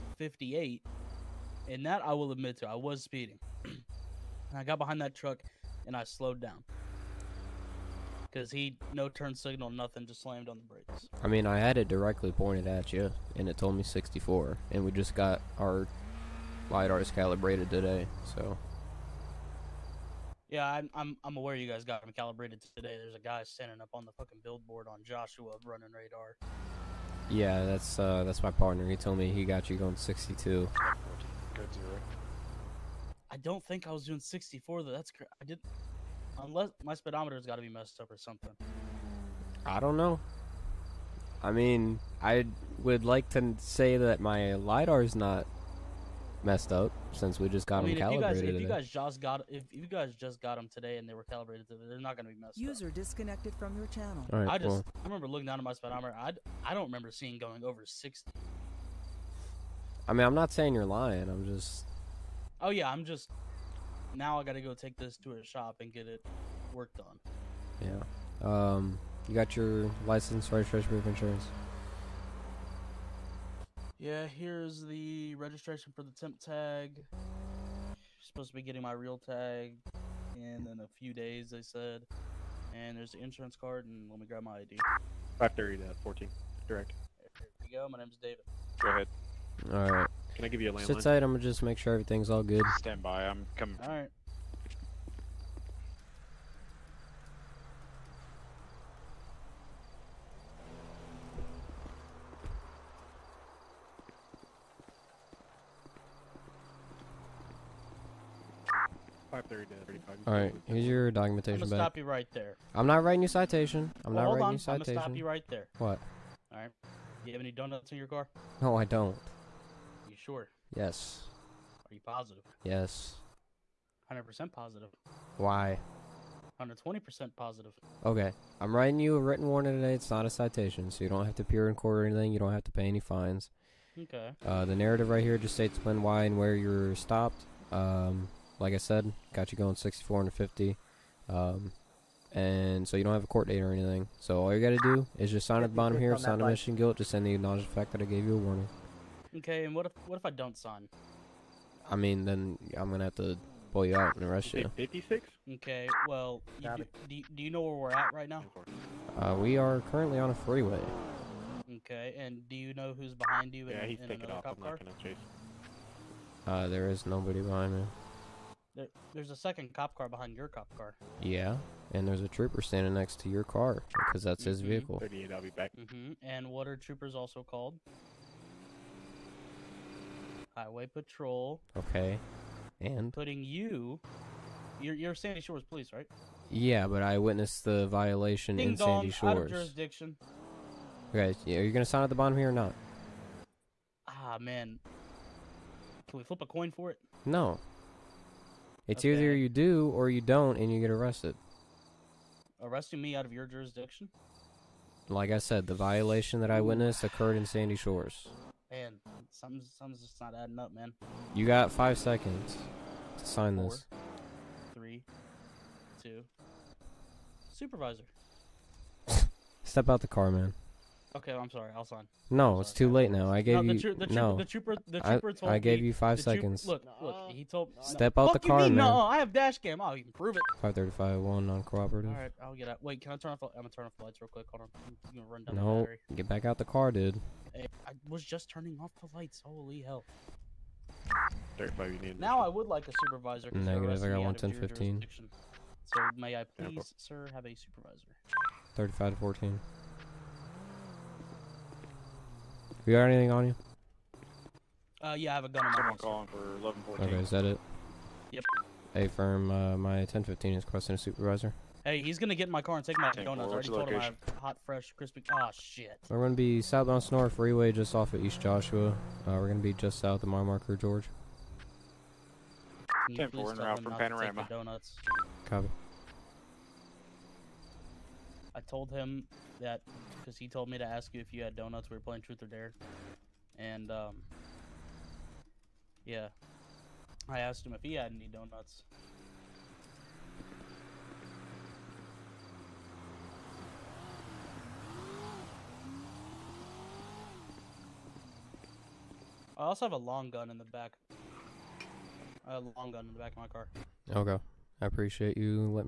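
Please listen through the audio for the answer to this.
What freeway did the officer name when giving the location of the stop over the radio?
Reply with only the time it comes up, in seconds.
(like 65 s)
266 s.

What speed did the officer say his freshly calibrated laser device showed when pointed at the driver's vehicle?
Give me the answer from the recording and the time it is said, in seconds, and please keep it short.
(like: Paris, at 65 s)
64, at 13 s.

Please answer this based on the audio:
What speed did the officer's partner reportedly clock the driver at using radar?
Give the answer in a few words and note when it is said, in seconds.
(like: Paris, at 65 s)
62, at 29 s.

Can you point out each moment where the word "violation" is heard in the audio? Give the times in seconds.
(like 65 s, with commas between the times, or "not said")
187 s, 205 s.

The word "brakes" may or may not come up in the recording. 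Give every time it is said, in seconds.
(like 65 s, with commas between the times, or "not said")
10 s.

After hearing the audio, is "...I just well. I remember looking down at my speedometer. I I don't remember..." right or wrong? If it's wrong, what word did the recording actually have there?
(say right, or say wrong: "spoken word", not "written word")
right.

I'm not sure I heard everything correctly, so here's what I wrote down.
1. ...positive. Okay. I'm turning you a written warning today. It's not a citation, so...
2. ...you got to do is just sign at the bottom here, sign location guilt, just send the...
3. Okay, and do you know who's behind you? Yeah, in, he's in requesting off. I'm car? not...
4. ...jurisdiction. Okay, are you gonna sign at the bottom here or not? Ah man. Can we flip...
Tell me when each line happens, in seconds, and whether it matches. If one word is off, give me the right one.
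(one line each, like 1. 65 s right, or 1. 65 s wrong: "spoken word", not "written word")
1. 127 s wrong: "writing", not "turning"
2. 144 s wrong: "admission", not "location"
3. 161 s wrong: "taking", not "requesting"
4. 189 s right.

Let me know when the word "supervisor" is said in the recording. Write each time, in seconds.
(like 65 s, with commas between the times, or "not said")
217 s, 243 s, 247 s, 260 s.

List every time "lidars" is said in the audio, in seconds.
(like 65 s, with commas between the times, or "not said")
16 s, 44 s.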